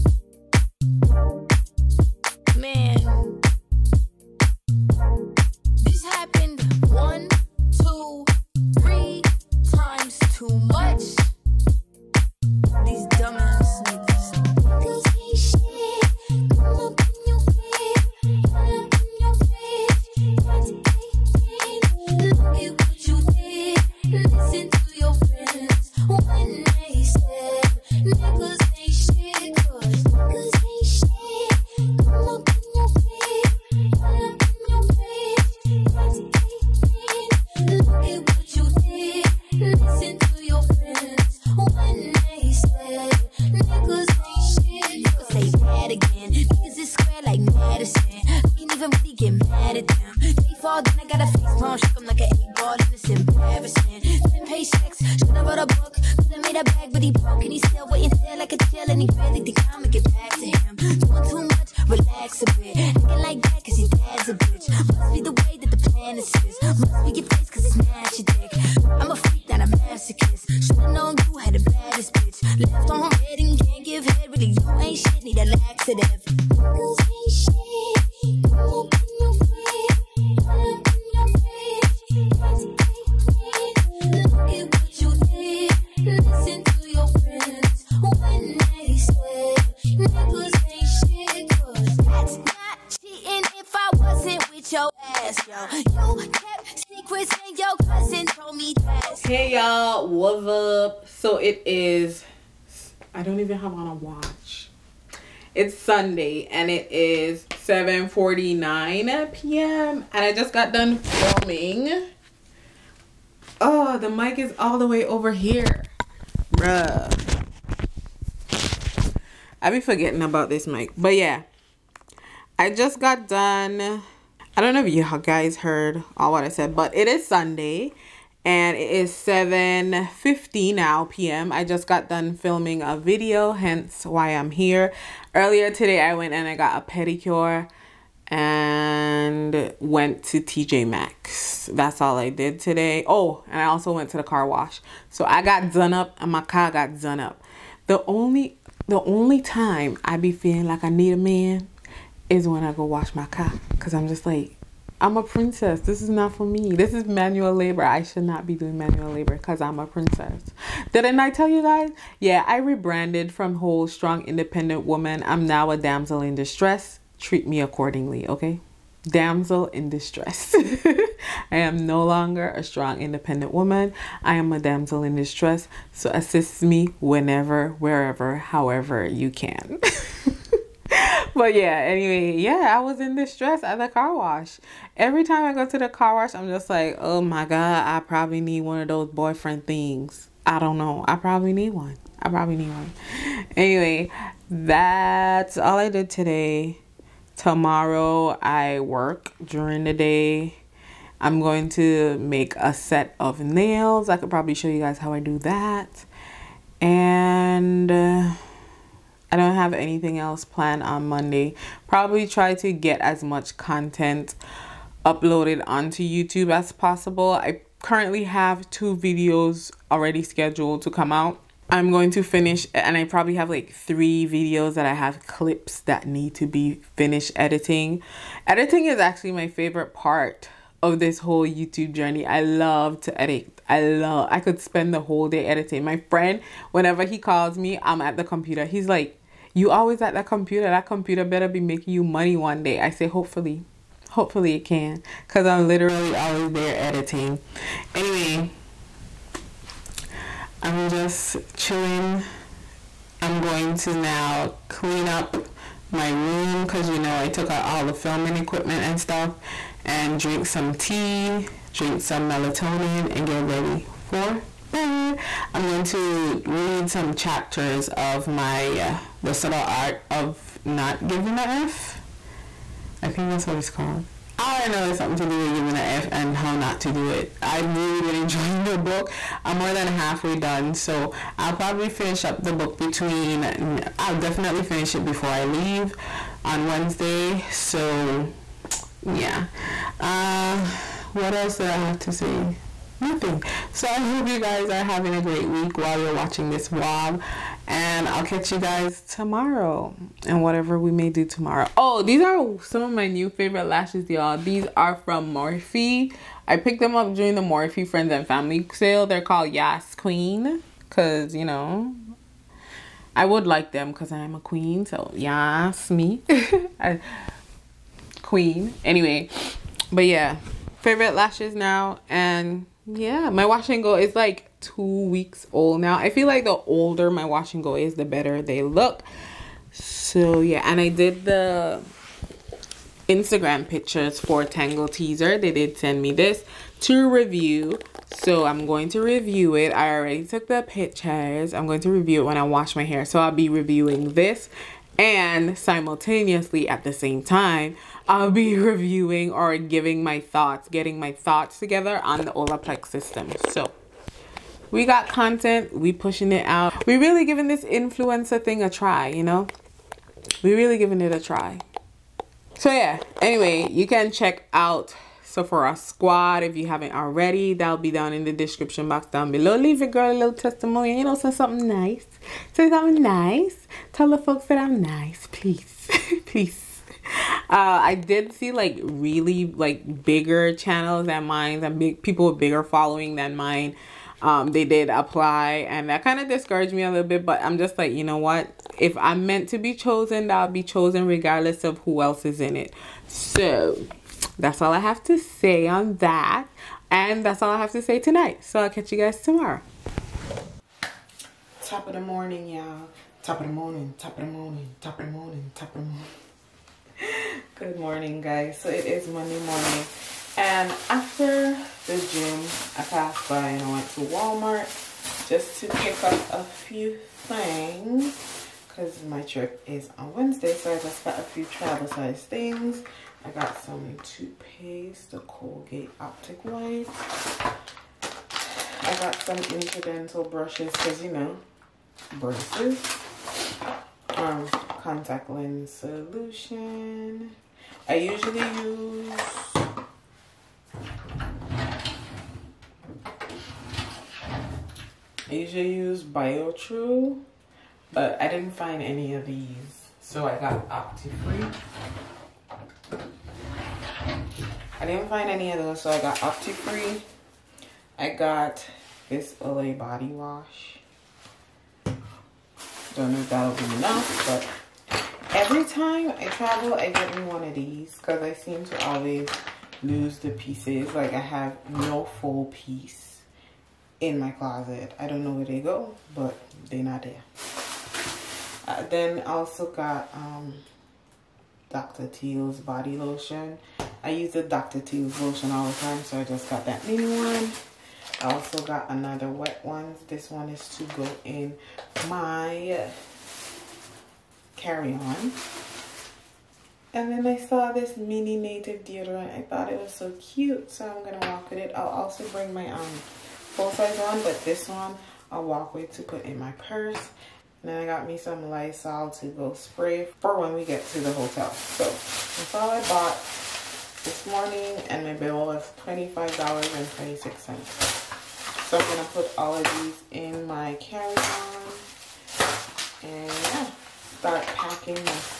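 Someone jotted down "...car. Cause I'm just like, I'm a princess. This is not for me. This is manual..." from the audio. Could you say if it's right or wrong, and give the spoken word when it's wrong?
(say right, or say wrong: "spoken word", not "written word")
right.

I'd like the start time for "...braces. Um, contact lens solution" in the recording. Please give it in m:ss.
7:12.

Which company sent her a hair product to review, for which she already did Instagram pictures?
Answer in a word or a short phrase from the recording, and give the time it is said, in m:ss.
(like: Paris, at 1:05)
Tangle Teezer, at 5:34.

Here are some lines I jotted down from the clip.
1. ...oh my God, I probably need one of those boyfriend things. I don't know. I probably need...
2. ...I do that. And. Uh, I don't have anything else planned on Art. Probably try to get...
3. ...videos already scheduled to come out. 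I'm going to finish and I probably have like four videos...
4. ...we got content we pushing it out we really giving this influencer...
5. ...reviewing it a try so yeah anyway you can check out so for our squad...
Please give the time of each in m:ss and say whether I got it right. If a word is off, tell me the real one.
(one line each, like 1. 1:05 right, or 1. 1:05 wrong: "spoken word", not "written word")
1. 3:07 right
2. 3:25 wrong: "Monday", not "Art"
3. 3:38 wrong: "three", not "four"
4. 5:54 right
5. 6:00 wrong: "giving", not "reviewing".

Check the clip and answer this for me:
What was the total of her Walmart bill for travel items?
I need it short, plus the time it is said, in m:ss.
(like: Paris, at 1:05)
$25.26, at 8:35.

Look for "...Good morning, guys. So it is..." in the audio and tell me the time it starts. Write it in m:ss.
6:47.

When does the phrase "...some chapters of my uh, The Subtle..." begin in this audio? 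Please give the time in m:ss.
4:26.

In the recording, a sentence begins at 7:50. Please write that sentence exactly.
Like I have no full piece in my closet.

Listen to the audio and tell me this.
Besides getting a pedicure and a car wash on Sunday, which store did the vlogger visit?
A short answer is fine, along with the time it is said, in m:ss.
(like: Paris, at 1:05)
TJ Maxx, at 2:20.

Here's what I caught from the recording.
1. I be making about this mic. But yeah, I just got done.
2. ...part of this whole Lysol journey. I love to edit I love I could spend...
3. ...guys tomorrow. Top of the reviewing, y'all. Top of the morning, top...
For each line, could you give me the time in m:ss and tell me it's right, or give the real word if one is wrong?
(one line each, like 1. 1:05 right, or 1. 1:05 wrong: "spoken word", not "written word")
1. 1:59 wrong: "forgetting", not "making"
2. 3:49 wrong: "YouTube", not "Lysol"
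3. 6:38 wrong: "morning", not "reviewing".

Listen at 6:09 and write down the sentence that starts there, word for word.
Leave your girl a little testimonial.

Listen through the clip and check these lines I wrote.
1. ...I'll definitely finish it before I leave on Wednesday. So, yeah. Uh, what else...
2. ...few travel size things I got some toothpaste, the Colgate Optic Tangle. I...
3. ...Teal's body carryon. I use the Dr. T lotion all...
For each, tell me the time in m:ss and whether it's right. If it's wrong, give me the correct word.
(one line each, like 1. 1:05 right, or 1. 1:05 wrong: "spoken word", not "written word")
1. 4:43 right
2. 7:01 wrong: "White", not "Tangle"
3. 8:02 wrong: "lotion", not "carryon".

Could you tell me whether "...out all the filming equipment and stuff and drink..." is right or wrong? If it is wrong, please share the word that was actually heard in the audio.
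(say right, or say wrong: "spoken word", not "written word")
right.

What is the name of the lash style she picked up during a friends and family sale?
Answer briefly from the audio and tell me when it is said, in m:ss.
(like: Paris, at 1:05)
Yas Queen, at 5:09.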